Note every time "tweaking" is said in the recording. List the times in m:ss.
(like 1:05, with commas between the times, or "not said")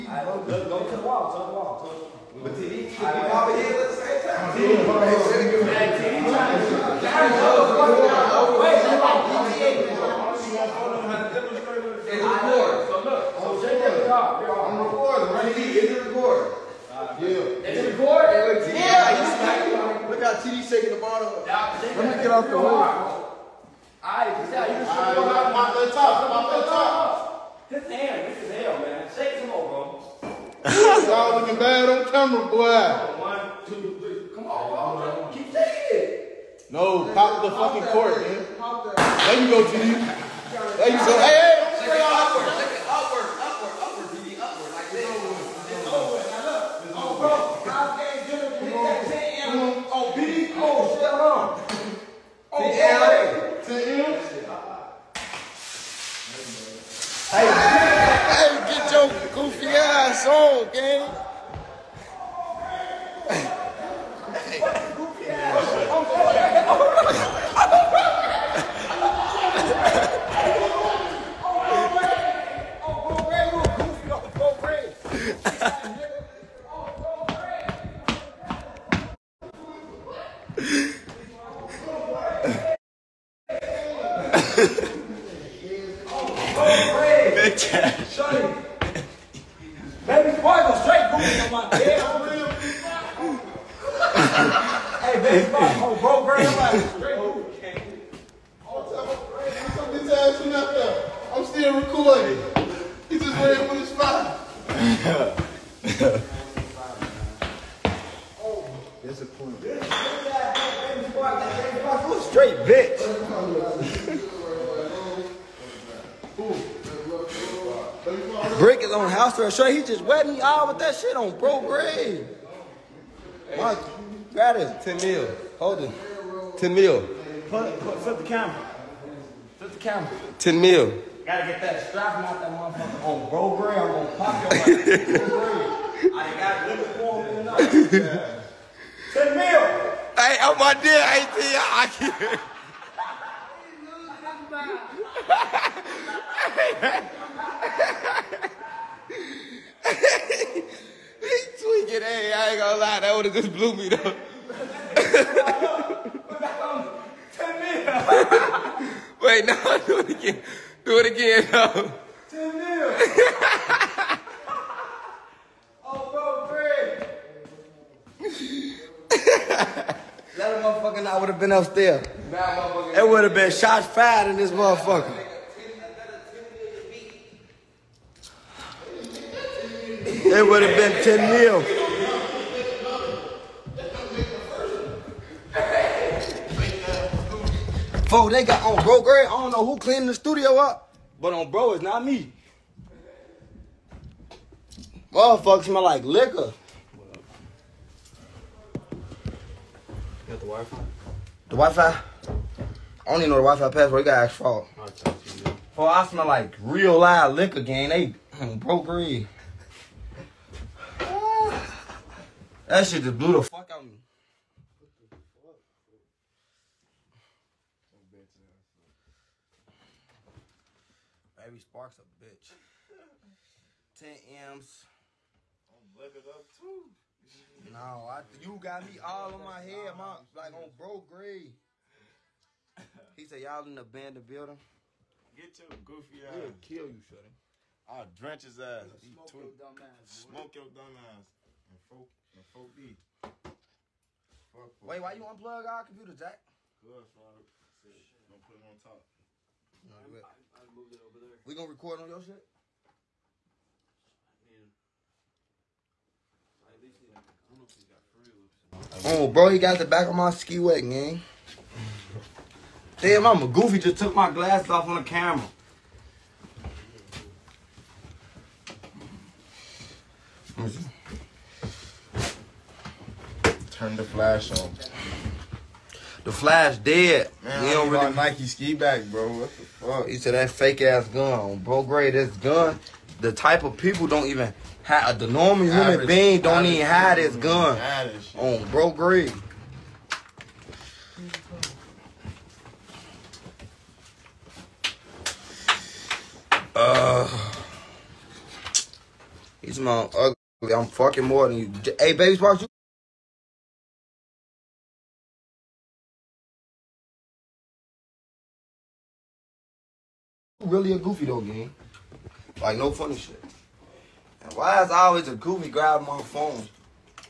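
2:31.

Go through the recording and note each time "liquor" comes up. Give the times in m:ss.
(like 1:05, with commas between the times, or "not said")
3:16, 3:27.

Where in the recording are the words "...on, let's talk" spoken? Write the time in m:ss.
0:25.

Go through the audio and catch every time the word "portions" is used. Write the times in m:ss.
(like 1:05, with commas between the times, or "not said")
not said.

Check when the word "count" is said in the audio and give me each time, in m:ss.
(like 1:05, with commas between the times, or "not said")
not said.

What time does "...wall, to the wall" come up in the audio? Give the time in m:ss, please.
0:01.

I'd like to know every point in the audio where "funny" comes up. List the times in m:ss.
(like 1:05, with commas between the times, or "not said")
5:12.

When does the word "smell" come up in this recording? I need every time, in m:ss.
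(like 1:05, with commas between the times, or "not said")
3:15, 3:26.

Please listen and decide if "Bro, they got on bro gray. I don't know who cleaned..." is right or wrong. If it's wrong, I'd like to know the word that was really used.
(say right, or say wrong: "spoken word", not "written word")
right.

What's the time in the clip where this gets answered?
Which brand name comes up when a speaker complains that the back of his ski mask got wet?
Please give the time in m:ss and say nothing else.
4:38.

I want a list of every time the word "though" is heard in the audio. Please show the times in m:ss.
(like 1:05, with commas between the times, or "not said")
2:33, 5:11.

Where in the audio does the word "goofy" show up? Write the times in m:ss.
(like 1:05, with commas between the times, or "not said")
0:59, 3:55, 4:23, 5:10, 5:15.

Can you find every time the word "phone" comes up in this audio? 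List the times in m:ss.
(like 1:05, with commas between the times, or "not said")
5:16.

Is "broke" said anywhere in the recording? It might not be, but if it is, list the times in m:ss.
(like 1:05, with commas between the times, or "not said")
2:01, 3:28.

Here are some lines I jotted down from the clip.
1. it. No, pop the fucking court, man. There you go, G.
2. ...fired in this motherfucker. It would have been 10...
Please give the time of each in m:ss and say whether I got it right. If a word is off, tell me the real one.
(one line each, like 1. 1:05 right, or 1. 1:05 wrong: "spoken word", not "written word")
1. 0:35 right
2. 2:53 right.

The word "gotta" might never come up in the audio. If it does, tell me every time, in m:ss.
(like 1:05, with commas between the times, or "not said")
2:11, 3:24.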